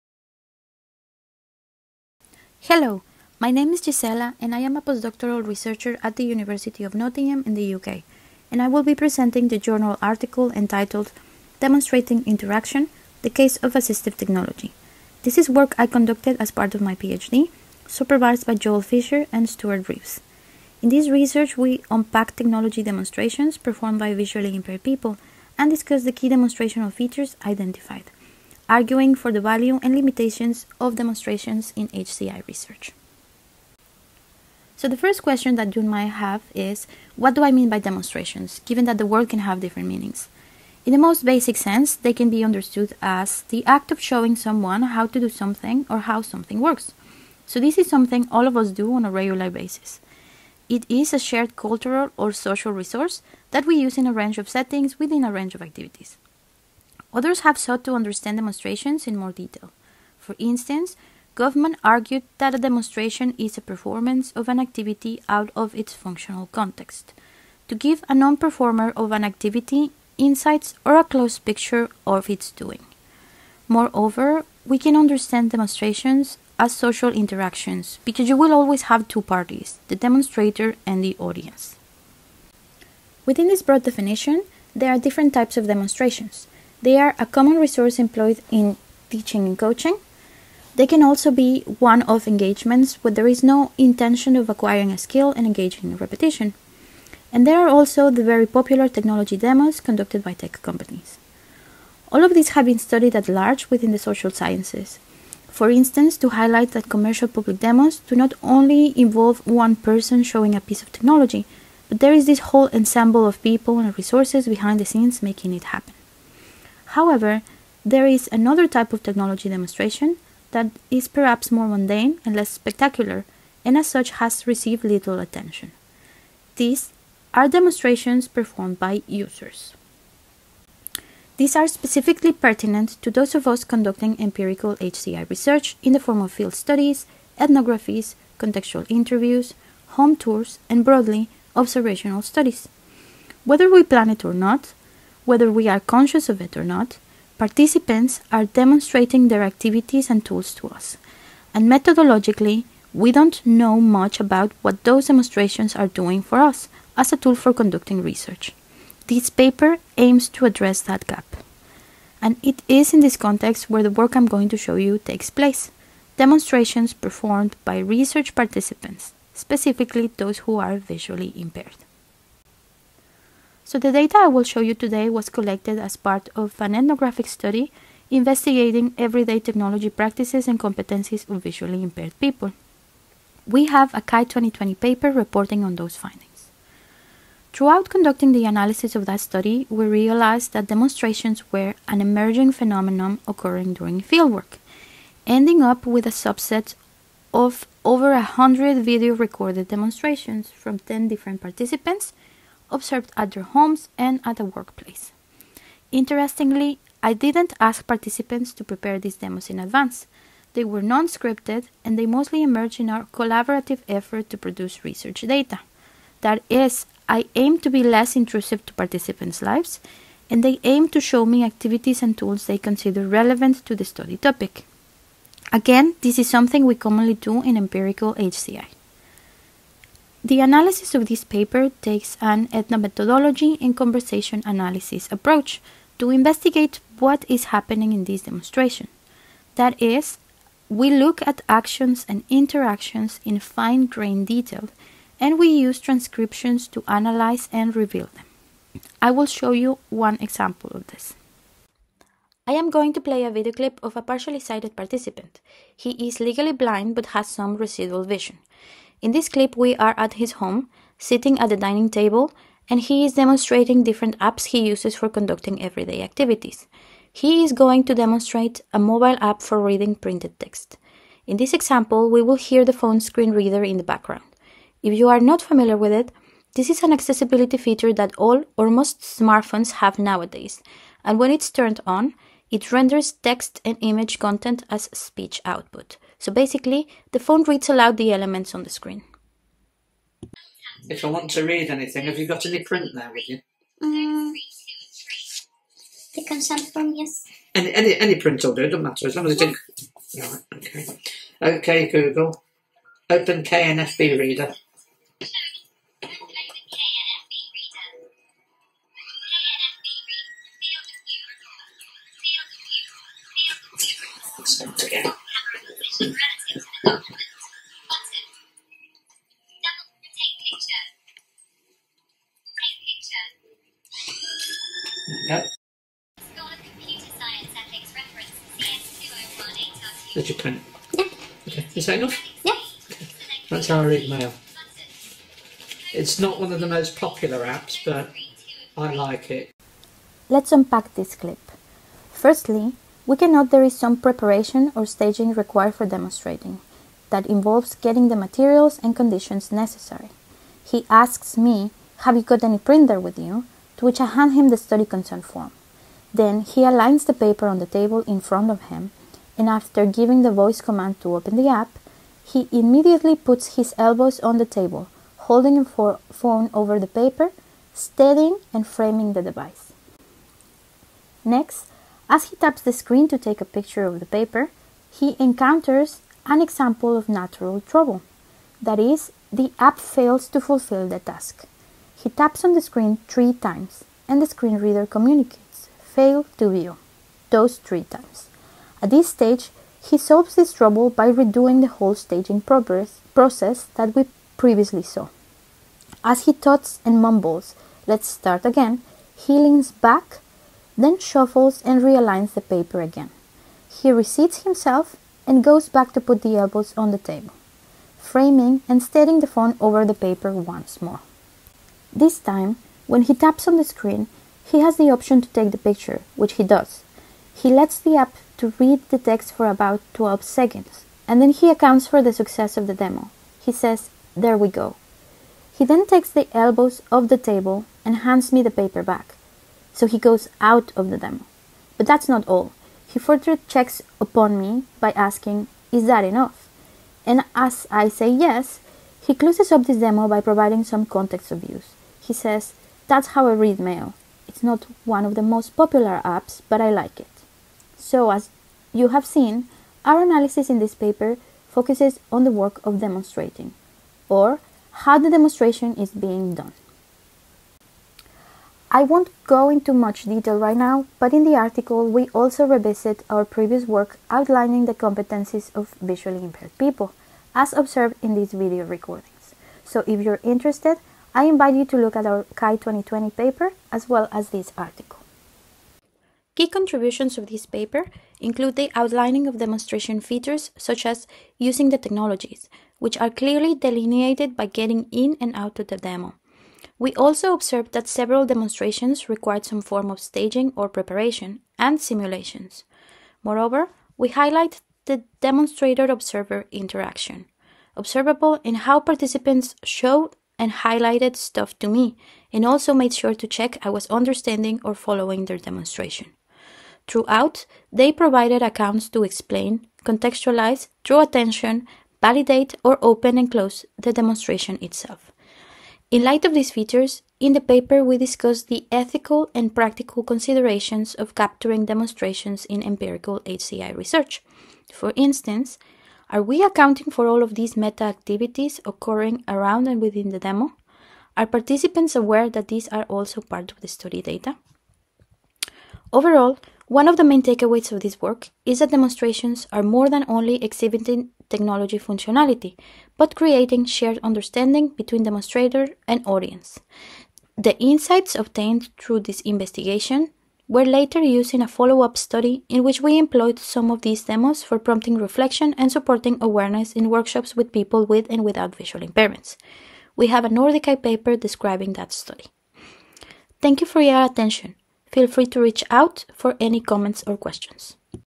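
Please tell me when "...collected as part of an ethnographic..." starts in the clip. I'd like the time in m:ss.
2:55.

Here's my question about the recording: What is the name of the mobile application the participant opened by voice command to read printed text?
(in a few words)
KNFB Reader.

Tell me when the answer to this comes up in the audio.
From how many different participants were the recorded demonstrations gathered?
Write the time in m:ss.
3:20.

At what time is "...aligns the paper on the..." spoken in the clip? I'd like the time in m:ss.
5:56.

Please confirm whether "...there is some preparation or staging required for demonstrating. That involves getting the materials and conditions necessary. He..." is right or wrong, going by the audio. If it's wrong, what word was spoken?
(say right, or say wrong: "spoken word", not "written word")
right.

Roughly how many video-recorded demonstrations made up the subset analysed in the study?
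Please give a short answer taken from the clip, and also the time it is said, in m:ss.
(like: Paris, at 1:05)
over 100, at 3:17.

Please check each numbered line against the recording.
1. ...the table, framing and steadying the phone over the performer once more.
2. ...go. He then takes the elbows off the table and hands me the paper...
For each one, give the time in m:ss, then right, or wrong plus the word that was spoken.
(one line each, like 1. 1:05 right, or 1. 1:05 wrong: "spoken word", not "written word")
1. 6:46 wrong: "paper", not "performer"
2. 7:04 right.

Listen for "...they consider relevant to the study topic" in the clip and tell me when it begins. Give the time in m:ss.
3:42.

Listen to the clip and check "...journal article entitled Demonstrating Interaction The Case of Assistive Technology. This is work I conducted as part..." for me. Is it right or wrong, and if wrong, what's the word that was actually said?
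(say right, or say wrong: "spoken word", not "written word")
right.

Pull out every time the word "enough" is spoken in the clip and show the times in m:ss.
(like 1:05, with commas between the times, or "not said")
5:31, 7:16.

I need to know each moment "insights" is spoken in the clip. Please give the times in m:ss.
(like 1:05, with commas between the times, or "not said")
1:10, 9:07.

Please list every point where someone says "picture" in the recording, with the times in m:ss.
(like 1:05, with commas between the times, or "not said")
1:11, 6:13, 6:55.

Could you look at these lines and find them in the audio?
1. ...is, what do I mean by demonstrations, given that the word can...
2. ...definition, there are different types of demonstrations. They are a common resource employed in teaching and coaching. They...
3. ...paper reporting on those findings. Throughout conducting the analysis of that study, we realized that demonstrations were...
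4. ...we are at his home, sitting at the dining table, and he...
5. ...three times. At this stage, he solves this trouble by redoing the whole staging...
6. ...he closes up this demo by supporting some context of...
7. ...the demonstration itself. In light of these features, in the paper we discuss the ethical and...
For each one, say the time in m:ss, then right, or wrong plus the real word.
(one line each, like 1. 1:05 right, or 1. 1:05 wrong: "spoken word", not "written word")
1. 0:36 right
2. 1:23 right
3. 3:04 right
4. 4:19 right
5. 6:27 right
6. 7:19 wrong: "providing", not "supporting"
7. 8:33 right.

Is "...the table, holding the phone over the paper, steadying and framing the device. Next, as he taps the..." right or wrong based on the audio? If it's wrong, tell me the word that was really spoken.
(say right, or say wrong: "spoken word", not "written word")
right.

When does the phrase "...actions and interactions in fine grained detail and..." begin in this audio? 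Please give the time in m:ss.
4:01.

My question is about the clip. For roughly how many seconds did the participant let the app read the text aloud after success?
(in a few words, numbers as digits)
12.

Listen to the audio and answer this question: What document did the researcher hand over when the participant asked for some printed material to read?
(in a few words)
The consent form.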